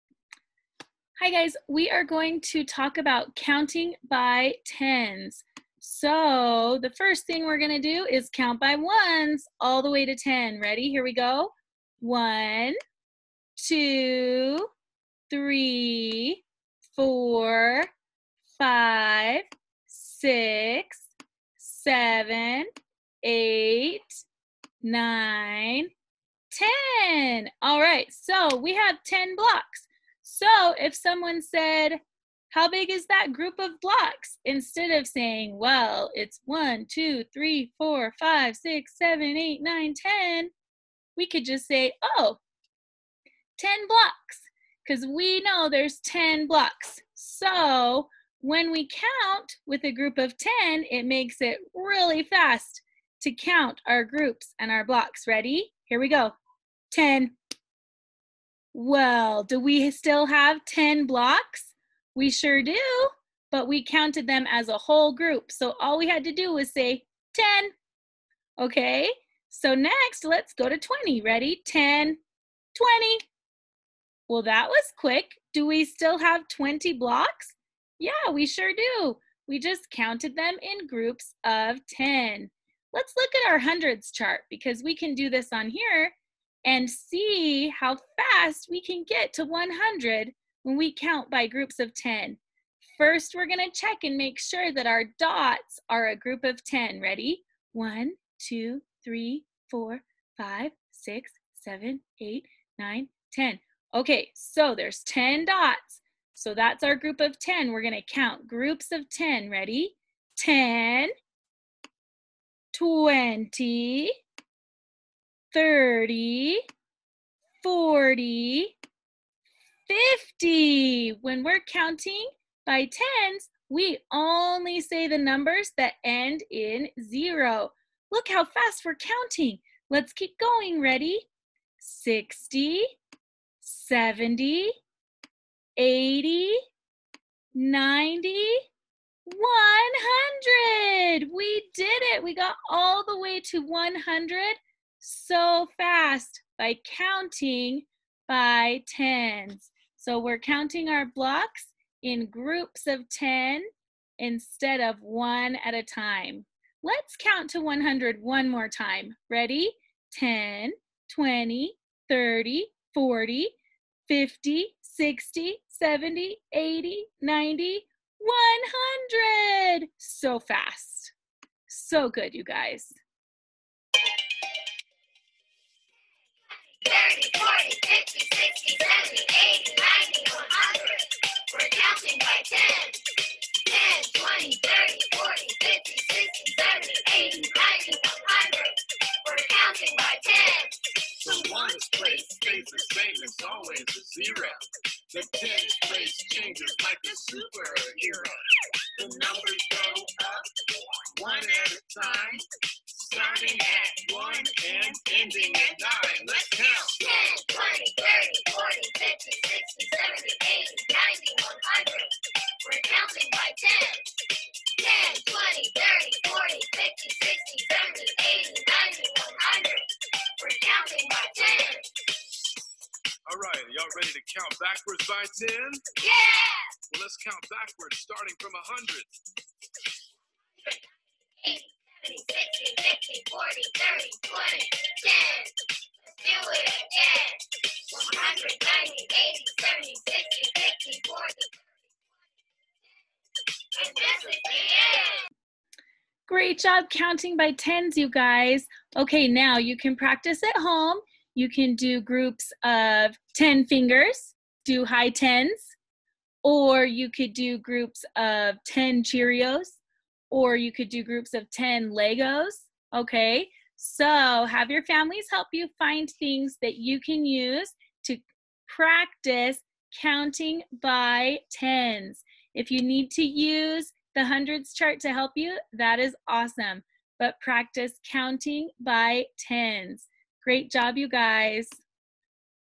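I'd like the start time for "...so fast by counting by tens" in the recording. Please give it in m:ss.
2:25.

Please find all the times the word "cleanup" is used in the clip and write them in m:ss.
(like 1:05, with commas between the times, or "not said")
not said.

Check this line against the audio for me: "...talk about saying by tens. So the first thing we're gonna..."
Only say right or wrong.
wrong.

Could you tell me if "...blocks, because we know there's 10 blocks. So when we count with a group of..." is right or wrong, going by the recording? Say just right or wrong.
right.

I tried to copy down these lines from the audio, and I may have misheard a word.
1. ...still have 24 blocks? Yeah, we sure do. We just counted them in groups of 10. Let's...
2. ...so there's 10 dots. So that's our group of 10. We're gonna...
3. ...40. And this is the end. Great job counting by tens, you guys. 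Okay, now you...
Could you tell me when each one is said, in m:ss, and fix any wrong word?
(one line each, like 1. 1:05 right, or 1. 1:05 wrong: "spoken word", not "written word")
1. 1:15 wrong: "20", not "24"
2. 1:44 right
3. 4:01 right.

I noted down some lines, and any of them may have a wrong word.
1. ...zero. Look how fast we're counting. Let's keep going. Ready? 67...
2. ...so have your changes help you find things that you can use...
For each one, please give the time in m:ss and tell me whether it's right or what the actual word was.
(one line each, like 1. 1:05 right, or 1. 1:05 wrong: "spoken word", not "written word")
1. 2:07 wrong: "60", not "67"
2. 4:23 wrong: "families", not "changes".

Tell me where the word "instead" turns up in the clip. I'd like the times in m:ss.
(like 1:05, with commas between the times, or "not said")
0:34, 2:34.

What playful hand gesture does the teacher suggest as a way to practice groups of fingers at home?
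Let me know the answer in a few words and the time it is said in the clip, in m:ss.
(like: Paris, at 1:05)
high tens, at 4:14.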